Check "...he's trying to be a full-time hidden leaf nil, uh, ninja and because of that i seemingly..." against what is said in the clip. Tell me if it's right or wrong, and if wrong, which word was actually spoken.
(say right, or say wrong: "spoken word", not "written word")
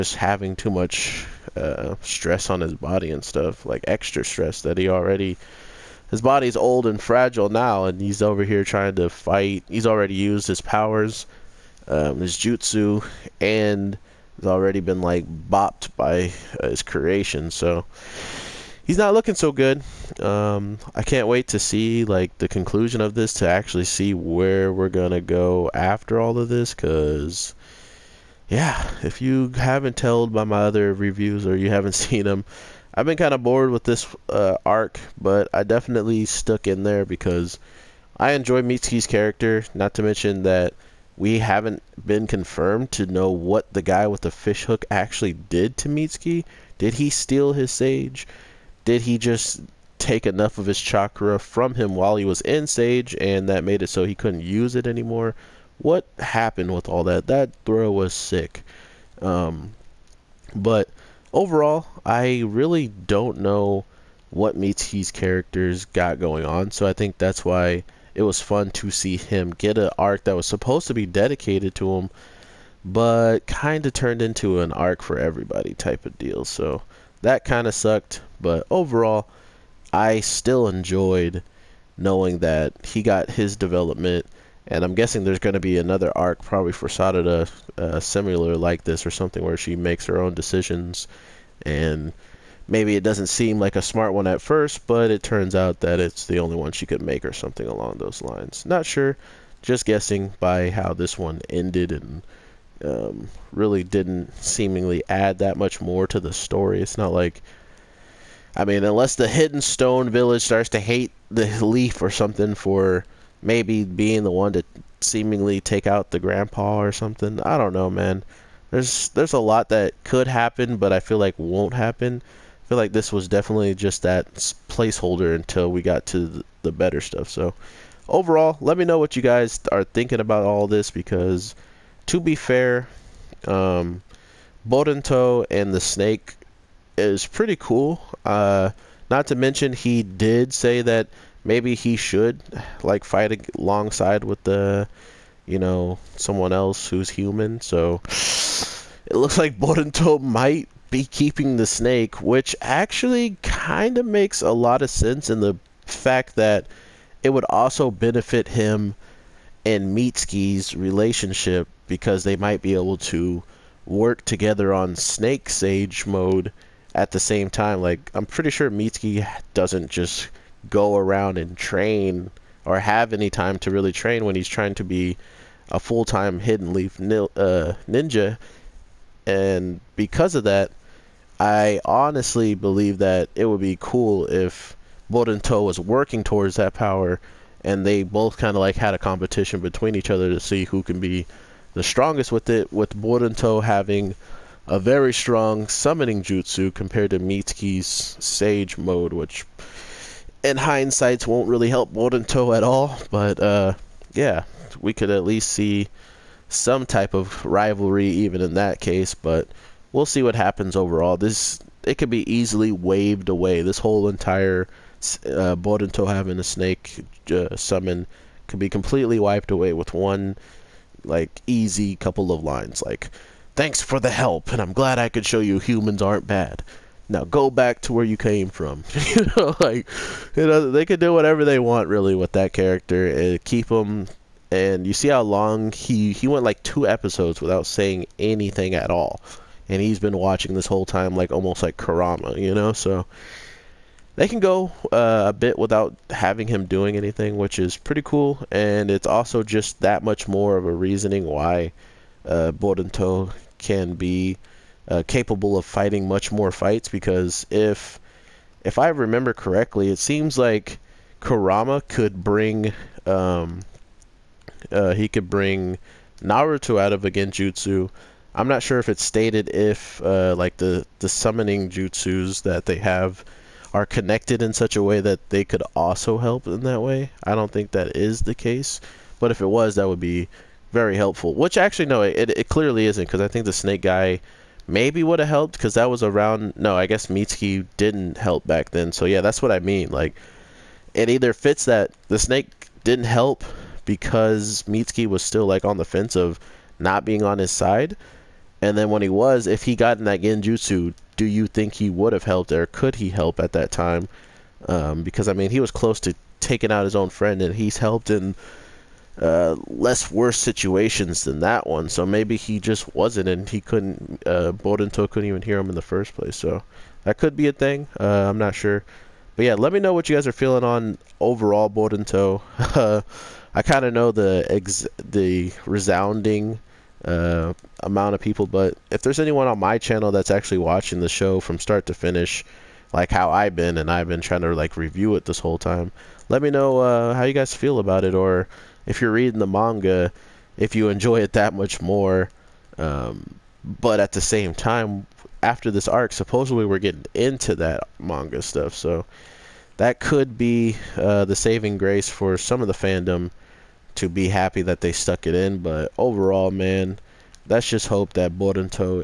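wrong: "honestly", not "seemingly".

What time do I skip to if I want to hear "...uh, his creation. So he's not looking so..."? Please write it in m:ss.
0:16.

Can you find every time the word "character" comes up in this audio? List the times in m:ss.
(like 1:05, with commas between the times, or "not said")
0:39, 1:05, 3:52.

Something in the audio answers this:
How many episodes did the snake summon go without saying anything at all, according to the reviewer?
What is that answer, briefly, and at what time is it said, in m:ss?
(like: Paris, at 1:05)
2, at 3:56.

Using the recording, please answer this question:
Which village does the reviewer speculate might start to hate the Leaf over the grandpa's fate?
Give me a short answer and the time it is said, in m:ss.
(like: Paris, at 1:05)
Hidden Stone Village, at 1:49.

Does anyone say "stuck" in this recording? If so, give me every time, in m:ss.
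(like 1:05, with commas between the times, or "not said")
0:36, 5:54.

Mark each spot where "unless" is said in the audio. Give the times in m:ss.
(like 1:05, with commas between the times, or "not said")
1:48.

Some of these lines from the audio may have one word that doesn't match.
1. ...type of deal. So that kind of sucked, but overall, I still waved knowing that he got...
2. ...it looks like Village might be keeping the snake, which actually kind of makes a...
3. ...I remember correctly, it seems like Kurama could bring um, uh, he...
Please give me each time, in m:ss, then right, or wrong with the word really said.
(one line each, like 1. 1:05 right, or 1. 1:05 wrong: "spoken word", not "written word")
1. 1:15 wrong: "enjoyed", not "waved"
2. 2:29 wrong: "Boruto", not "Village"
3. 4:18 right.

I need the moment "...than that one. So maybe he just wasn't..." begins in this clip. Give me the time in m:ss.
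5:11.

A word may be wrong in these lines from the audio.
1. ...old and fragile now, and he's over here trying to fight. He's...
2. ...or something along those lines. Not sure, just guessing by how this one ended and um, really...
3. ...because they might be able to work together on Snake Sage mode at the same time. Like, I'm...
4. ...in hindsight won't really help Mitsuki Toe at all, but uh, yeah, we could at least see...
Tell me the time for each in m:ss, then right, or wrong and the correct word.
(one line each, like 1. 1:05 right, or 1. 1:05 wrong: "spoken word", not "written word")
1. 0:06 right
2. 1:37 right
3. 2:41 right
4. 3:20 wrong: "Warden", not "Mitsuki".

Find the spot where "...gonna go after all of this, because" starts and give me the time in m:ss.
0:24.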